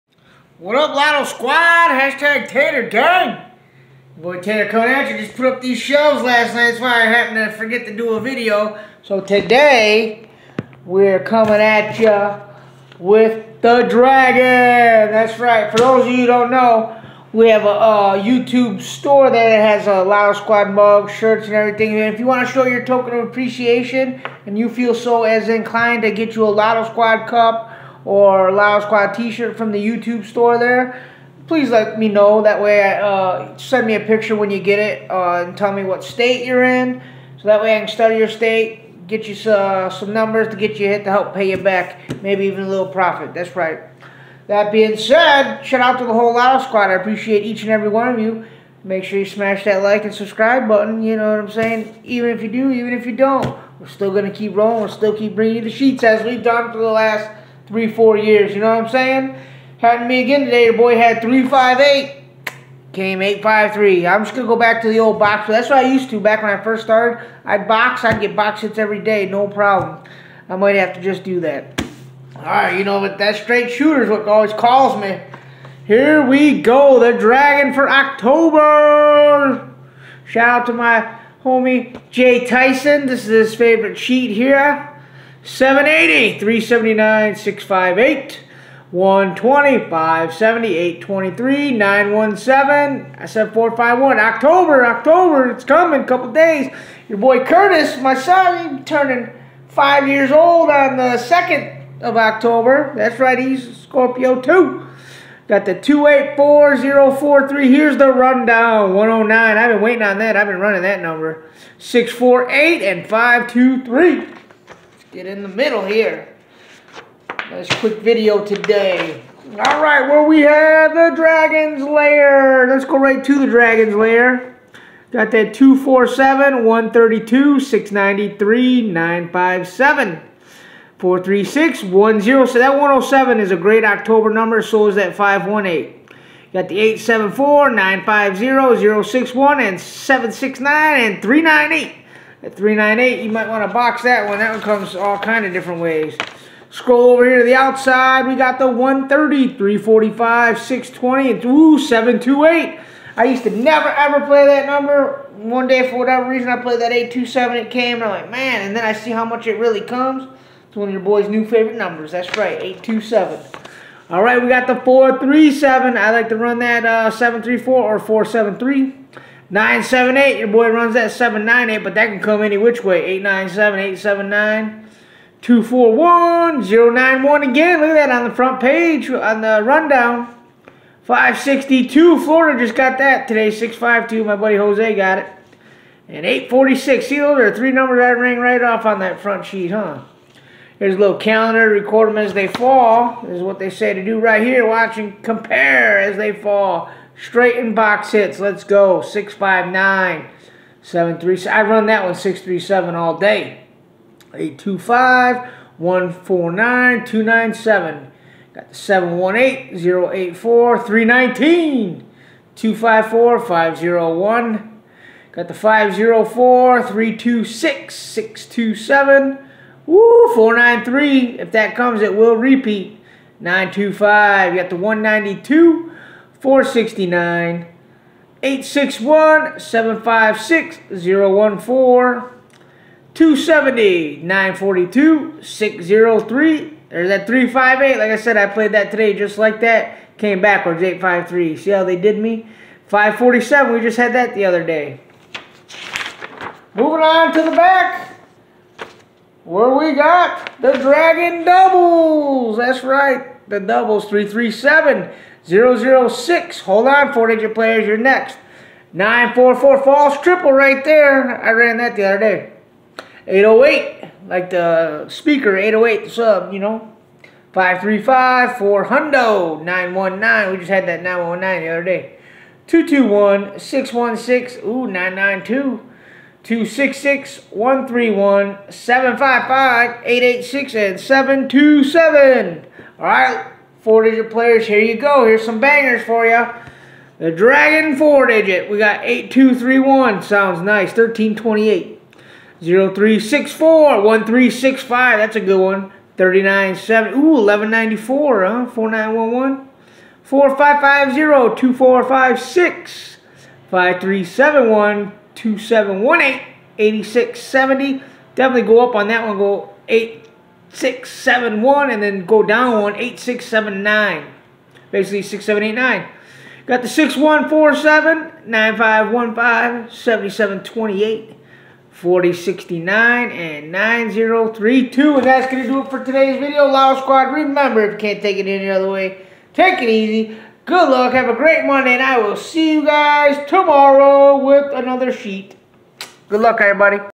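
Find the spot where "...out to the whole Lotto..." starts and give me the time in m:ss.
0:45.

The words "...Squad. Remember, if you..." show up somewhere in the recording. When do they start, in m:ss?
5:27.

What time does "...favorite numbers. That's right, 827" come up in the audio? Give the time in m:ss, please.
2:41.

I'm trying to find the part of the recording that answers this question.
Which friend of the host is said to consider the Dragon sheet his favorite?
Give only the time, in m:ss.
1:22.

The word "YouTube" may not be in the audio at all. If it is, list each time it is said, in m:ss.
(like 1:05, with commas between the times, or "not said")
0:18, 0:29.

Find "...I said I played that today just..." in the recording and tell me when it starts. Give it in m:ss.
3:58.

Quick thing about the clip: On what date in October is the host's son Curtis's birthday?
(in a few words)
2nd of October.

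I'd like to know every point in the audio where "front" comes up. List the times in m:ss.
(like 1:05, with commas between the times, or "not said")
2:58, 3:09.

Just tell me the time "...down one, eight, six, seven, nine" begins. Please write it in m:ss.
5:12.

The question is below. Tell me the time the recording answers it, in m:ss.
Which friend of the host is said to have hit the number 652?
3:04.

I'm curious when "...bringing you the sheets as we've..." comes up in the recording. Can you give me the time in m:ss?
0:55.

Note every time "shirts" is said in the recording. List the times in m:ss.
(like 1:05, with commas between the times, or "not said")
0:21, 0:29.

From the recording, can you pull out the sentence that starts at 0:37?
So that way I can study your state, get you uh, some numbers to get you hit to help pay you back.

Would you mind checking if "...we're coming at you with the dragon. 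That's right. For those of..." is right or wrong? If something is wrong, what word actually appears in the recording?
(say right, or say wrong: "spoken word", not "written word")
right.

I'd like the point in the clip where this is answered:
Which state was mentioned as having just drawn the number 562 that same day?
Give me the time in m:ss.
3:02.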